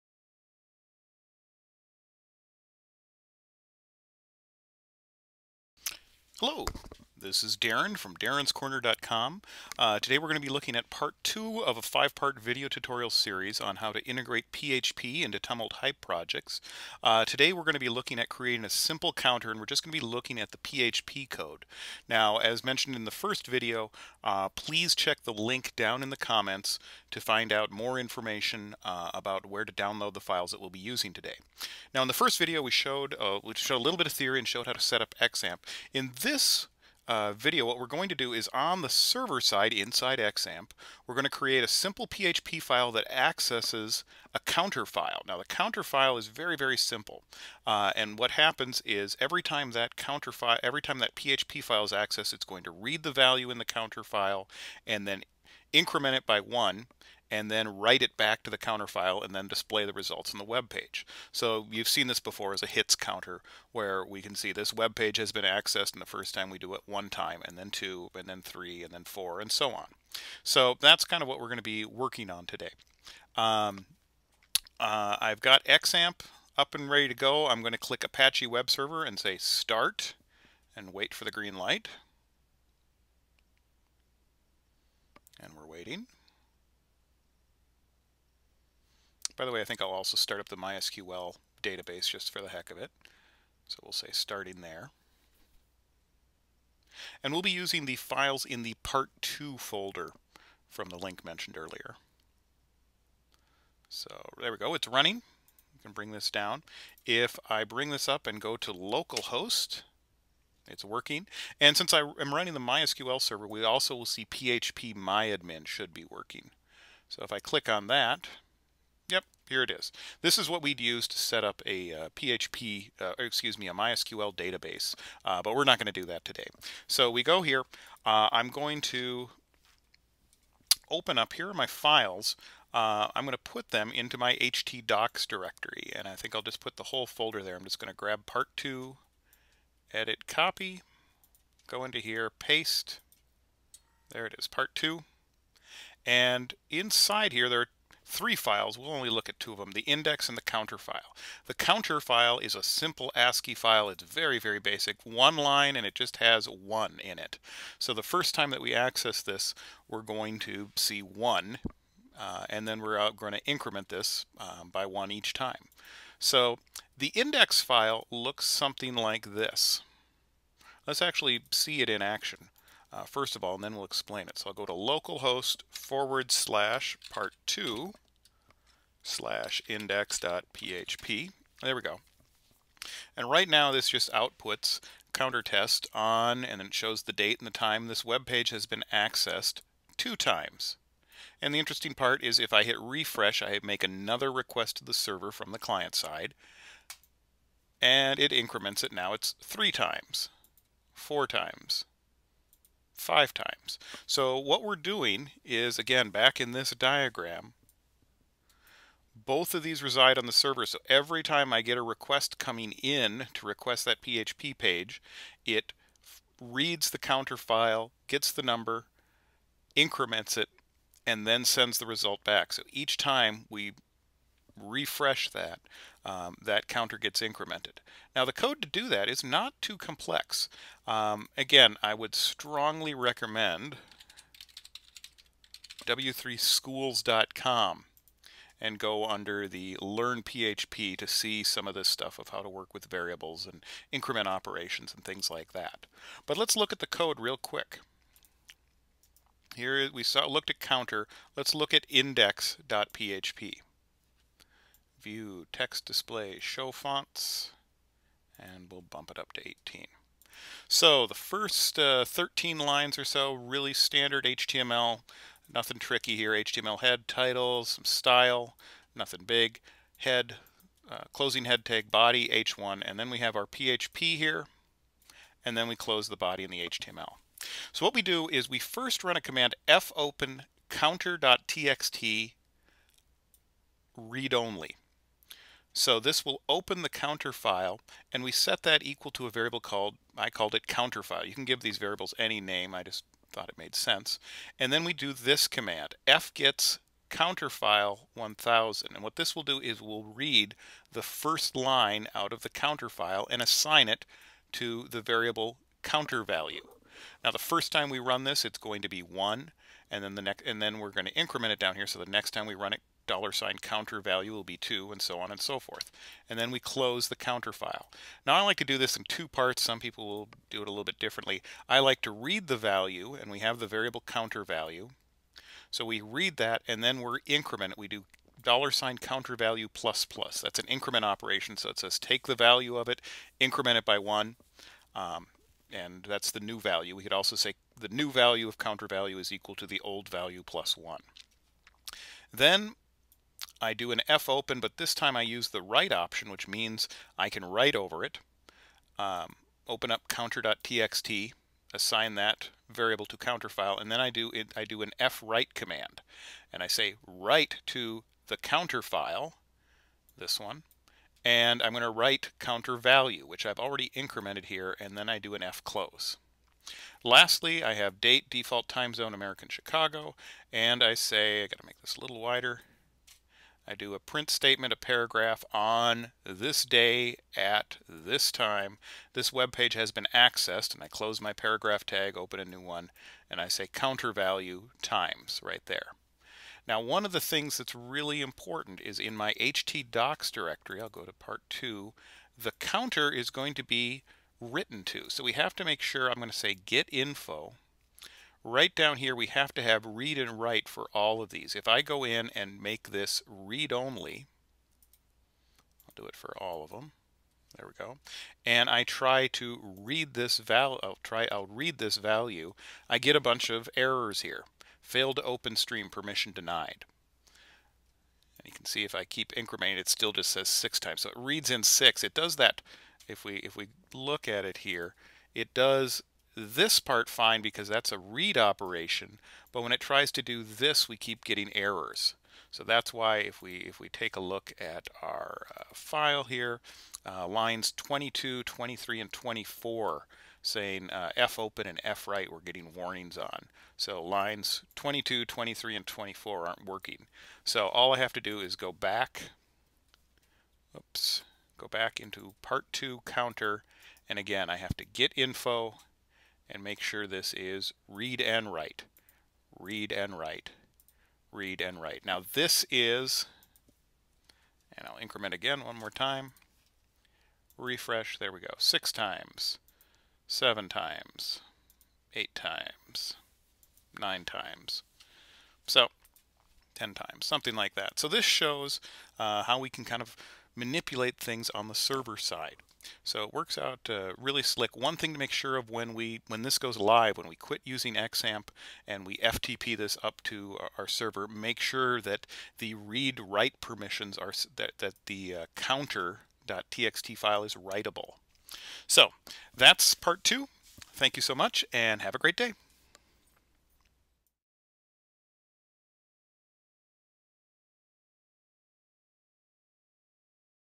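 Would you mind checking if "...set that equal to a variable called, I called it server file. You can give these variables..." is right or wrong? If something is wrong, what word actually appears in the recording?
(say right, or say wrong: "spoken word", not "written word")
wrong: "counter", not "server".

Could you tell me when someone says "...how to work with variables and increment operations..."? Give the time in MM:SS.
04:02.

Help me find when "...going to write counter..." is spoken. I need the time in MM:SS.
06:01.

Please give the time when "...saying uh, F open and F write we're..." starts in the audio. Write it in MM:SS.
07:20.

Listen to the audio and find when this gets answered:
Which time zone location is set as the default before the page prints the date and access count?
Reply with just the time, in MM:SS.
06:09.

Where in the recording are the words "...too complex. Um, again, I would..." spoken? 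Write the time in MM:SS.
03:49.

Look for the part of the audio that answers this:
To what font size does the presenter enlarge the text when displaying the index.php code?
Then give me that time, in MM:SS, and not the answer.
04:19.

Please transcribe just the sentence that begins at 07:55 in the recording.
So 10 times, something like that.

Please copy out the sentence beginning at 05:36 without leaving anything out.
We could also say the new value of counter value is equal to the old value plus 1.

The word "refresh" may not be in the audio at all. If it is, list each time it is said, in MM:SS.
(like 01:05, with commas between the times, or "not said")
03:12, 03:44, 07:47.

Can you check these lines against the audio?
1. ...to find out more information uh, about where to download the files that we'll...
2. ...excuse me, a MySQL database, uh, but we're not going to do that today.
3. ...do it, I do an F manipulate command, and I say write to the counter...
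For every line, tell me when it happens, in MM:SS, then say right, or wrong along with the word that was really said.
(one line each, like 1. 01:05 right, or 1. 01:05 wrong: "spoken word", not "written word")
1. 00:27 right
2. 02:03 right
3. 05:54 wrong: "write", not "manipulate".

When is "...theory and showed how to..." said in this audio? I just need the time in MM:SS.
00:34.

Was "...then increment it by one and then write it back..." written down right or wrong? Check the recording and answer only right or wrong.
right.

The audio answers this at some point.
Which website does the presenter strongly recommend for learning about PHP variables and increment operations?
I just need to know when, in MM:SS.
03:55.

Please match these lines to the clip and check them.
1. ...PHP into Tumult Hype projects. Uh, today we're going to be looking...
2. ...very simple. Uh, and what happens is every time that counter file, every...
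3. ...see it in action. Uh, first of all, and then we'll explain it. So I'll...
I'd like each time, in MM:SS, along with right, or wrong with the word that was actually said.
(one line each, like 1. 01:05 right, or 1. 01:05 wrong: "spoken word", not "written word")
1. 00:14 right
2. 00:46 right
3. 02:51 right.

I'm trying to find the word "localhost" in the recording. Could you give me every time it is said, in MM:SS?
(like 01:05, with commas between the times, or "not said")
01:48, 02:54.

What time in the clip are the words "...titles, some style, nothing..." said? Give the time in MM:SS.
04:27.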